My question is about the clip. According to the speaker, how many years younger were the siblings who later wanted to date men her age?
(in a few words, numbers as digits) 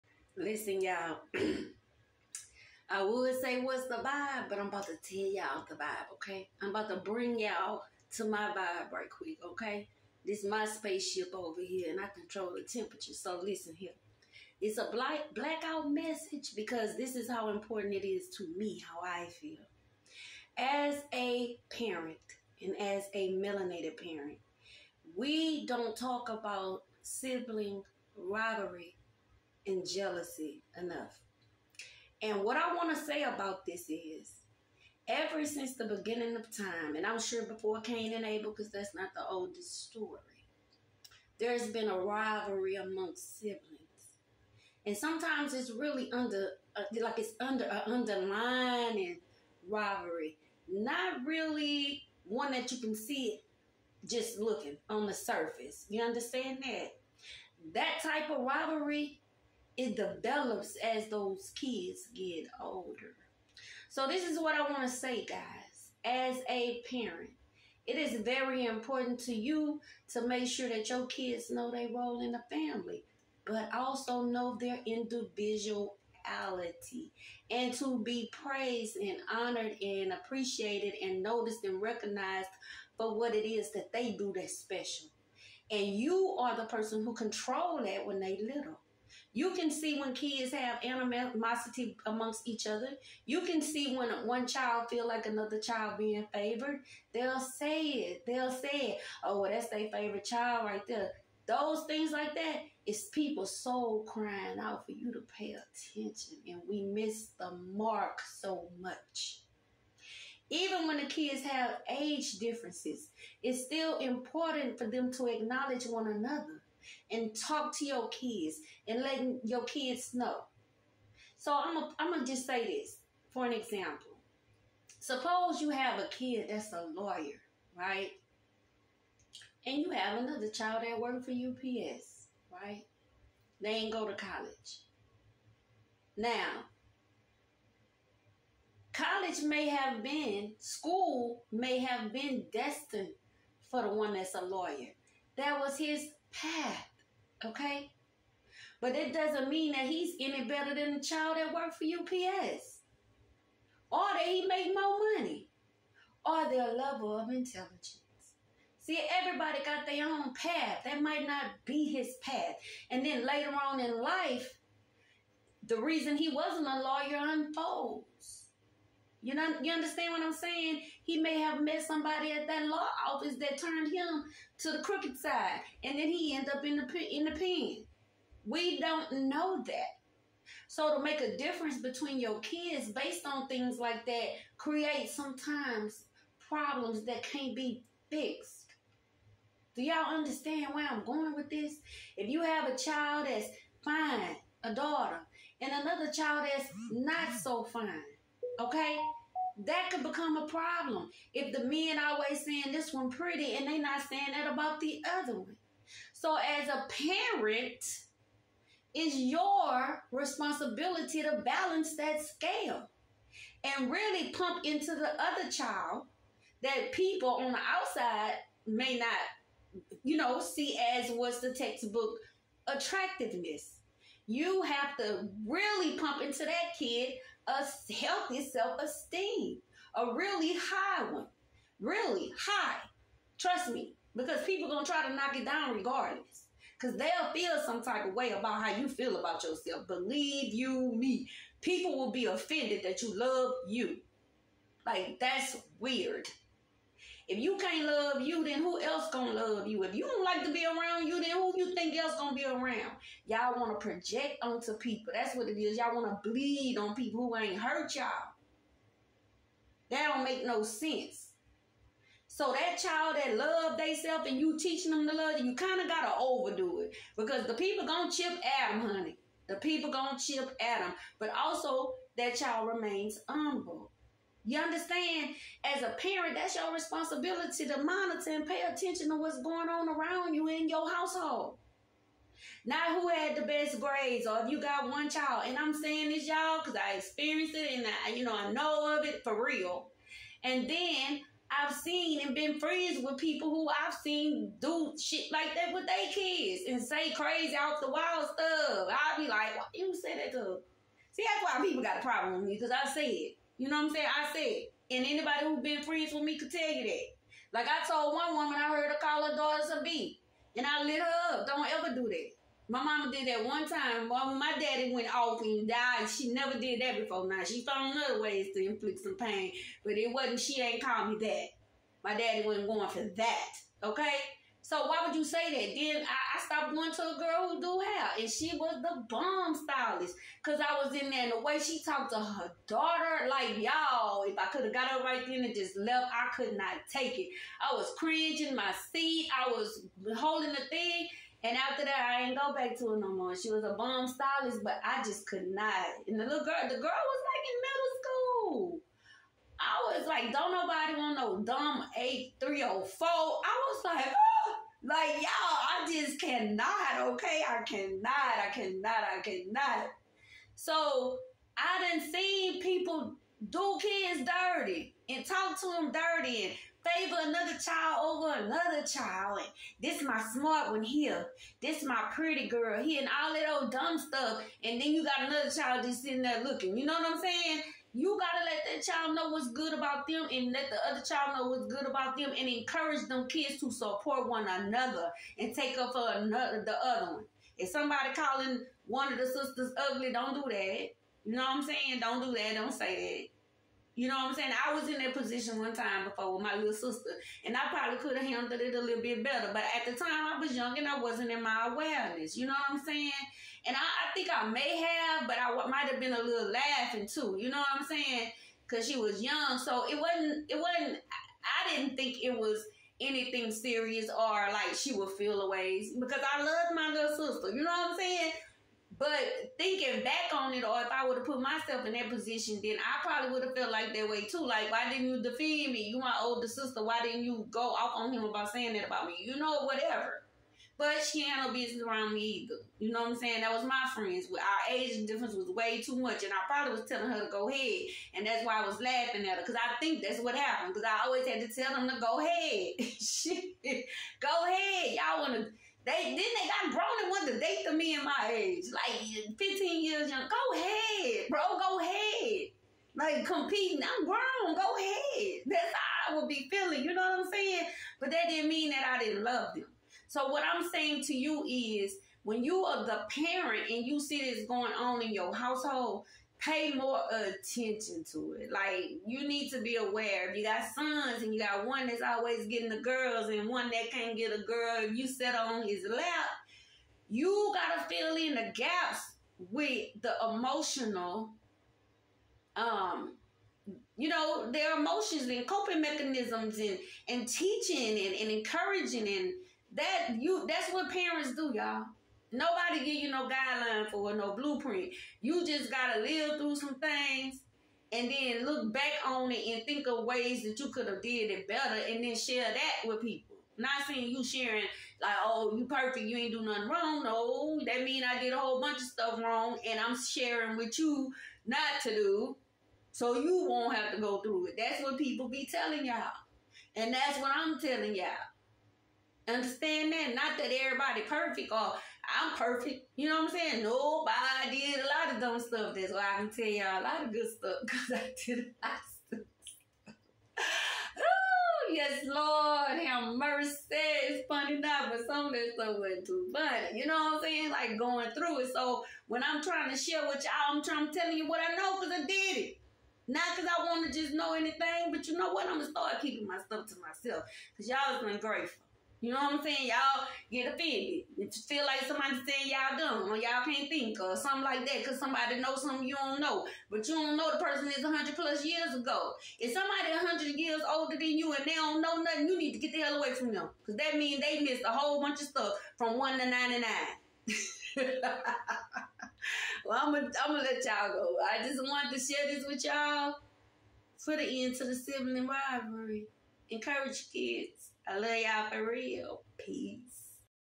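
15.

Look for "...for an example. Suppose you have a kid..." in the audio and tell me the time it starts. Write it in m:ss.
2:03.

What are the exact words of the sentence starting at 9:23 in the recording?
Because that means they missed a whole bunch of stuff from 1 to 99.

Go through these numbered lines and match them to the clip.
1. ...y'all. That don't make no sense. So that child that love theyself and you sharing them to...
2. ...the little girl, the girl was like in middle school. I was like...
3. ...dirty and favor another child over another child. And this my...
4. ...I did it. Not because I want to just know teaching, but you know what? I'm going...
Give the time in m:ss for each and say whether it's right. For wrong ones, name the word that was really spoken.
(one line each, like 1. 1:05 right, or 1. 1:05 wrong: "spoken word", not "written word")
1. 4:17 wrong: "teaching", not "sharing"
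2. 5:46 right
3. 6:05 right
4. 9:02 wrong: "anything", not "teaching".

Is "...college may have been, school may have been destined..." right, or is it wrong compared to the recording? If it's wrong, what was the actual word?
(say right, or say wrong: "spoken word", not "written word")
right.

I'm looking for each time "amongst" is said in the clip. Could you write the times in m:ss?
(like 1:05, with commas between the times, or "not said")
0:42, 1:32.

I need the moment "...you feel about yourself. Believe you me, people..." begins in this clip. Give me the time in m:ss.
3:58.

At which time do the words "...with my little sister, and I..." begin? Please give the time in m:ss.
6:36.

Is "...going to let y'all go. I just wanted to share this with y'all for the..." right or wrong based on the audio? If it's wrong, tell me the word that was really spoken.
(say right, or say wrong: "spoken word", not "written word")
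right.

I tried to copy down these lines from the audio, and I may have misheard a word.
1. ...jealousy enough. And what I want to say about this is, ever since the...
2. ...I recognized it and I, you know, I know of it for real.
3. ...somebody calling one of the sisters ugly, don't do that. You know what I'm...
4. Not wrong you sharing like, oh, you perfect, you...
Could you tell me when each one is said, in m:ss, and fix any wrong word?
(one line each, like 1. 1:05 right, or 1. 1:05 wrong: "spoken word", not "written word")
1. 0:29 right
2. 4:46 wrong: "experienced", not "recognized"
3. 6:27 right
4. 8:23 wrong: "seeing", not "wrong".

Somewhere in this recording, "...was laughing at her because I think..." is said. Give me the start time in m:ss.
7:18.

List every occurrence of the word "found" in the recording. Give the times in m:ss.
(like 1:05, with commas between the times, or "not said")
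5:17.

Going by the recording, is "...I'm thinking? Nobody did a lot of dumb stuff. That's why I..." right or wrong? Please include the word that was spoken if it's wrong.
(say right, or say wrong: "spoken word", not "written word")
wrong: "saying", not "thinking".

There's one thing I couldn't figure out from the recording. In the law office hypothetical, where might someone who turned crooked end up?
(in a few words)
The pen.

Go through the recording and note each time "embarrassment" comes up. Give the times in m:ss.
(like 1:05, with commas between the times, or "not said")
not said.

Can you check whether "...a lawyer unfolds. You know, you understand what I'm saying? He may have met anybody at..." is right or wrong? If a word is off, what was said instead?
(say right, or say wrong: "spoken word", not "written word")
wrong: "somebody", not "anybody".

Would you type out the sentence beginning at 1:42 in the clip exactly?
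It's people soul crying out for you to pay attention.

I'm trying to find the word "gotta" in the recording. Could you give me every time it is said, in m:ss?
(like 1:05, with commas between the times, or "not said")
4:25, 6:18, 7:57, 8:15.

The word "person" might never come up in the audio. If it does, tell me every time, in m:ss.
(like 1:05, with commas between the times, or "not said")
1:26, 9:17.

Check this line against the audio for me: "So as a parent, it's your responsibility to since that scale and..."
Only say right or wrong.
wrong.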